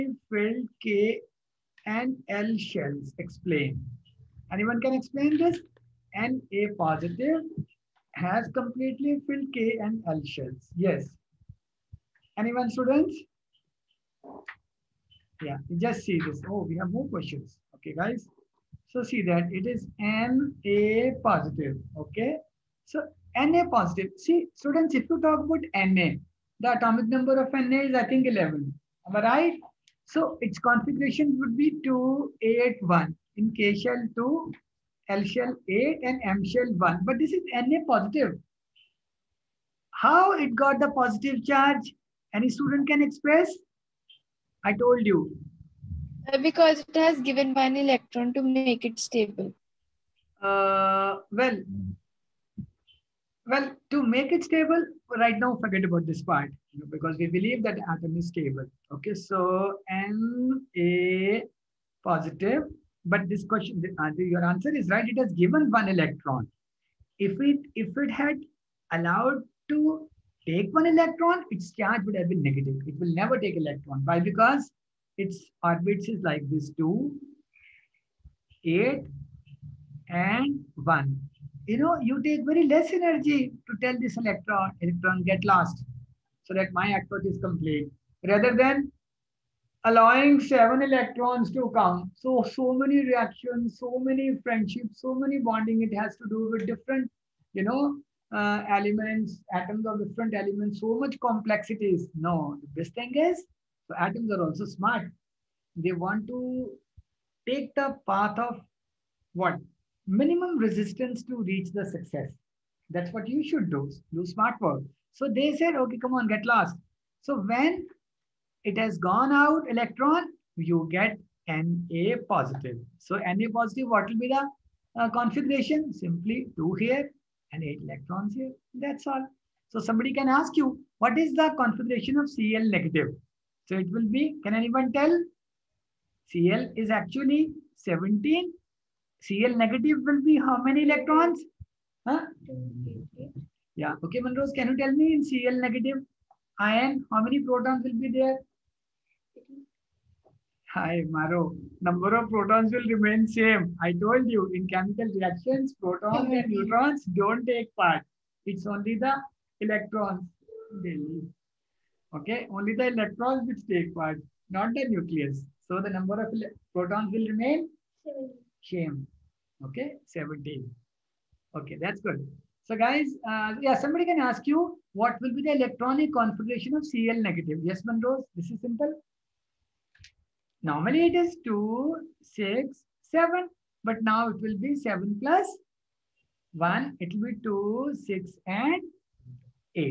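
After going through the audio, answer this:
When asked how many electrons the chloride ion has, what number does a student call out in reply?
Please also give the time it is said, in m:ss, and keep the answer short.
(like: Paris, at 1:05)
28, at 2:22.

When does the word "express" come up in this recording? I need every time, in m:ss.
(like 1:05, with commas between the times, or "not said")
0:43.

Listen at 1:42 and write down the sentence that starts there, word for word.
No, the best thing is so atoms are also smart.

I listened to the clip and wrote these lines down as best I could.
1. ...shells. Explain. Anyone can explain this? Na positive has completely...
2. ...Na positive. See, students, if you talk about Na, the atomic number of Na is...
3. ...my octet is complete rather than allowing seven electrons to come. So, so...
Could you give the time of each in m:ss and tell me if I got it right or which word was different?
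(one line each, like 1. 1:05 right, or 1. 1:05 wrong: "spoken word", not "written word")
1. 0:02 right
2. 0:23 right
3. 1:26 right.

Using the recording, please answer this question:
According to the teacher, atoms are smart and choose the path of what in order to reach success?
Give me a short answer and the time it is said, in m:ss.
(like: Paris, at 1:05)
Minimum resistance, at 1:50.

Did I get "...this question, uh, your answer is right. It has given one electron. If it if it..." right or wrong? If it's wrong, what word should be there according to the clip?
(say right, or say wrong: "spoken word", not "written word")
right.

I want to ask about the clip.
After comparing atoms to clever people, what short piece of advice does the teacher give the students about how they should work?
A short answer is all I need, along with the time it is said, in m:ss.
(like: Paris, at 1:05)
Do smart work, at 1:54.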